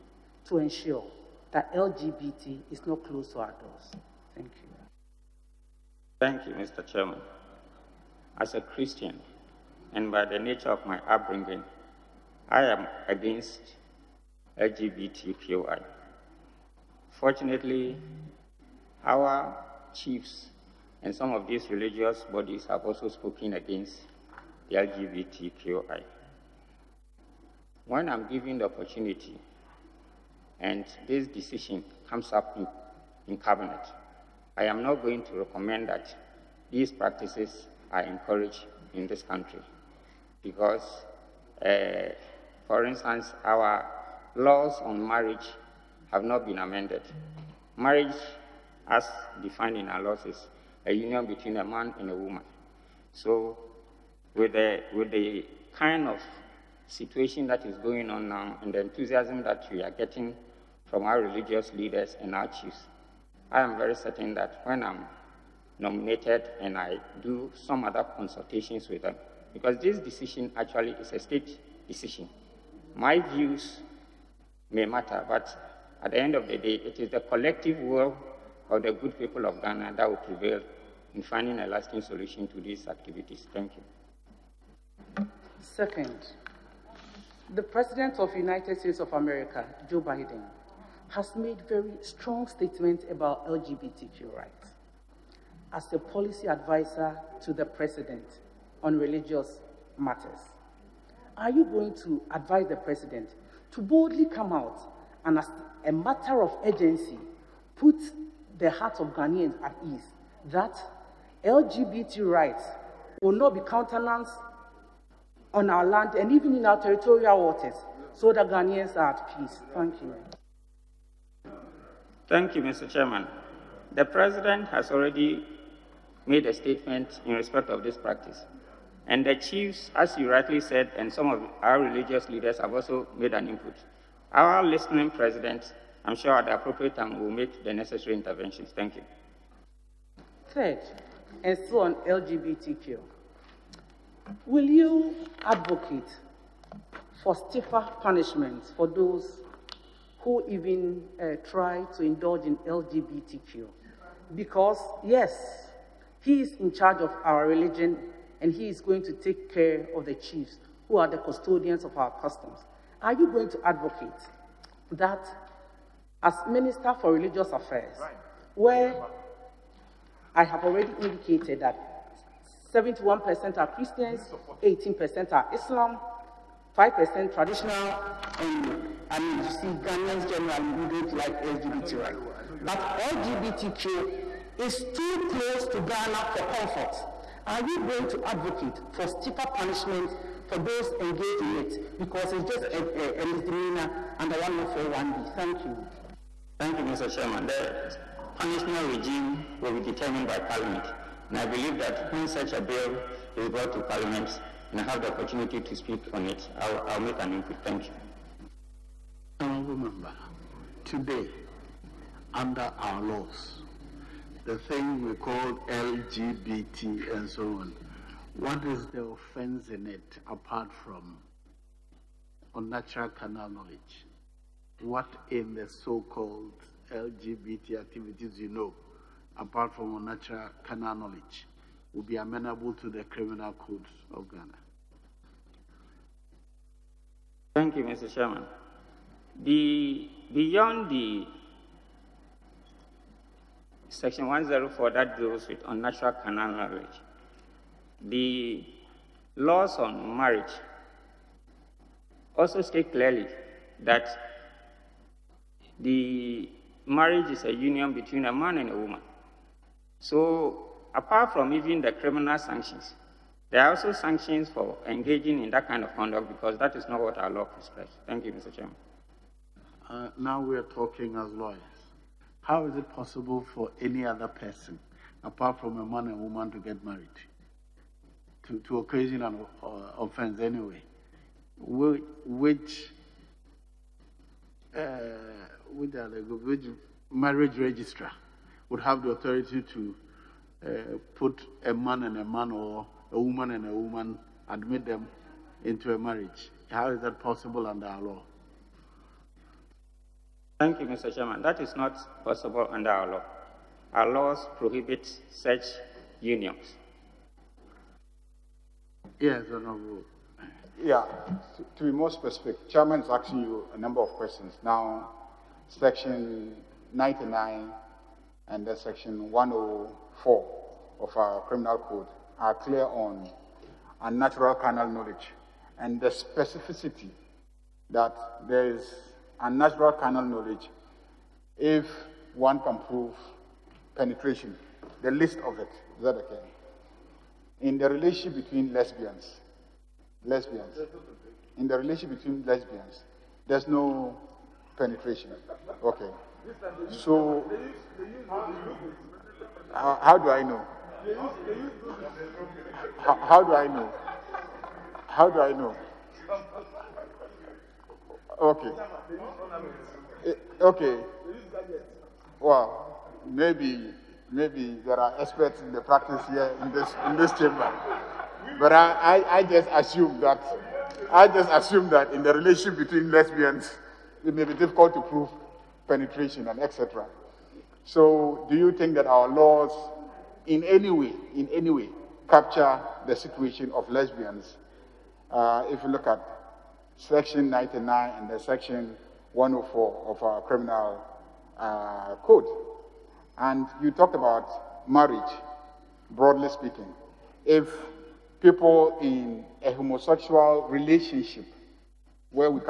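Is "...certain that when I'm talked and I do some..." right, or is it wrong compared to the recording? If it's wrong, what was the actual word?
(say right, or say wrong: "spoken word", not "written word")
wrong: "nominated", not "talked".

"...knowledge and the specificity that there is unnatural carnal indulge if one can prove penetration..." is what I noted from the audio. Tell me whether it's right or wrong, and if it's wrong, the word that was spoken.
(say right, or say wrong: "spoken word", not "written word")
wrong: "knowledge", not "indulge".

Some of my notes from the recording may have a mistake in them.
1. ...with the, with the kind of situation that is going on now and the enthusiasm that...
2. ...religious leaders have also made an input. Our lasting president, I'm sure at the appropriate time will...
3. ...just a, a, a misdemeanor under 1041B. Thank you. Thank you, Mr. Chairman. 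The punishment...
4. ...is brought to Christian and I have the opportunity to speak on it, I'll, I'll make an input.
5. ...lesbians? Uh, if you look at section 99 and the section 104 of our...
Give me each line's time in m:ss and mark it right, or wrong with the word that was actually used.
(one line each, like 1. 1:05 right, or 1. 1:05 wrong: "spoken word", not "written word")
1. 0:54 right
2. 2:11 wrong: "listening", not "lasting"
3. 3:12 right
4. 3:23 wrong: "Parliament", not "Christian"
5. 6:23 right.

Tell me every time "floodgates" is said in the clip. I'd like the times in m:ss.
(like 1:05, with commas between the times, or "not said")
not said.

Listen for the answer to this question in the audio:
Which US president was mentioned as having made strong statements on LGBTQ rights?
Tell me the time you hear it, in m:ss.
1:29.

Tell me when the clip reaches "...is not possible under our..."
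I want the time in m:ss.
5:01.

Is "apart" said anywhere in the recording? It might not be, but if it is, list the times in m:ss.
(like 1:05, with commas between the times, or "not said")
3:40, 3:49, 4:20, 4:35.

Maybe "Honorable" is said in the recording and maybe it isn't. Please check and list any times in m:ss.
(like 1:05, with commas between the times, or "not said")
3:29, 5:09.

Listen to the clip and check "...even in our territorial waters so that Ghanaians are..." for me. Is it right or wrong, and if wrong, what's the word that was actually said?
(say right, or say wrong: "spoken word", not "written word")
right.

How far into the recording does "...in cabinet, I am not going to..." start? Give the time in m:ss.
0:33.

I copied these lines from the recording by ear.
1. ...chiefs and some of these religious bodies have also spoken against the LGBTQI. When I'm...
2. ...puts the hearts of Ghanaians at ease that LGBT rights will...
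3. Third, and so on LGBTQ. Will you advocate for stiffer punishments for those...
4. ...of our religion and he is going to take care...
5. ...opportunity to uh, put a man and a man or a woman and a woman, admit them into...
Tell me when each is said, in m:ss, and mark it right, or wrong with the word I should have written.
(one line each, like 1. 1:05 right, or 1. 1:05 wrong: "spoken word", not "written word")
1. 0:19 right
2. 1:47 right
3. 2:20 right
4. 2:37 right
5. 4:49 wrong: "authority", not "opportunity".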